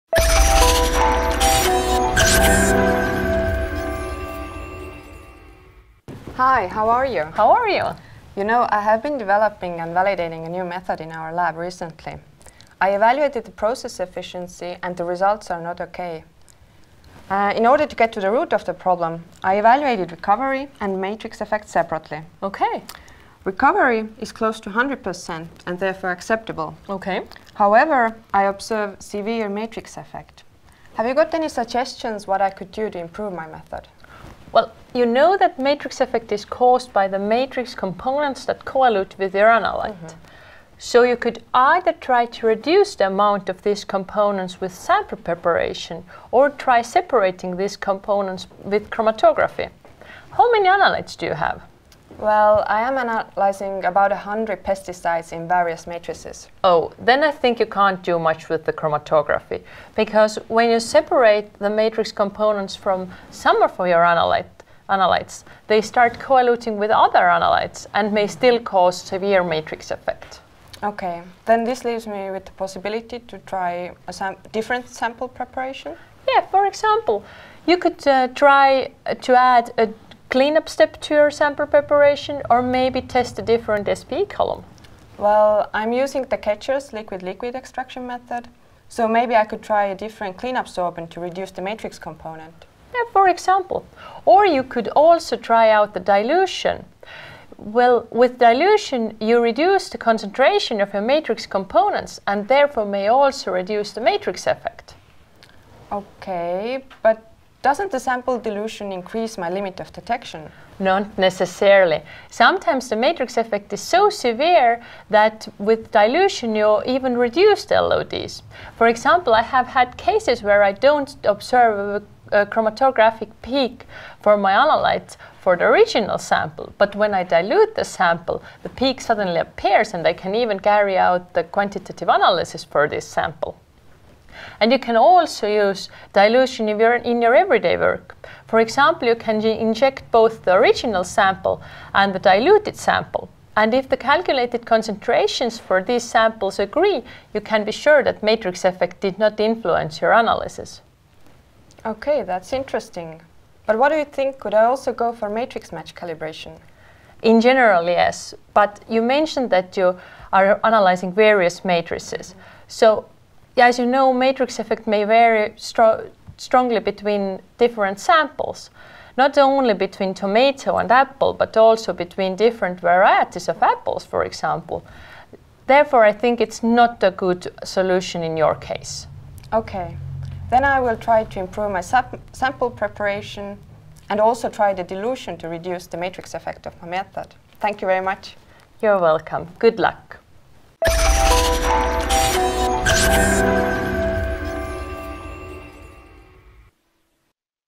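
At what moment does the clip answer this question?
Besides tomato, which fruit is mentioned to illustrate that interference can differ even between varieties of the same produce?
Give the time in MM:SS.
02:50.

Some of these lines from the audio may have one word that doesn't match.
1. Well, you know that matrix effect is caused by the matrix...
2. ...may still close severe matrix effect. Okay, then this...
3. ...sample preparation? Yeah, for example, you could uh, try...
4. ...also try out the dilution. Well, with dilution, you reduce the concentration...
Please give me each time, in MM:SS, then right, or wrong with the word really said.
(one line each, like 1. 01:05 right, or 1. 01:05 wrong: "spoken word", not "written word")
1. 00:34 right
2. 01:08 wrong: "cause", not "close"
3. 01:14 right
4. 01:34 right.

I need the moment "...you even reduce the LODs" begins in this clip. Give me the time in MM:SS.
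01:56.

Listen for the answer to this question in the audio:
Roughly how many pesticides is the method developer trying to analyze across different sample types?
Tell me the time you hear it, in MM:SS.
00:53.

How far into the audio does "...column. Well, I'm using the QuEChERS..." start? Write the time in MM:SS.
01:24.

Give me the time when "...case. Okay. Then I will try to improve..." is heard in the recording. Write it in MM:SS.
02:58.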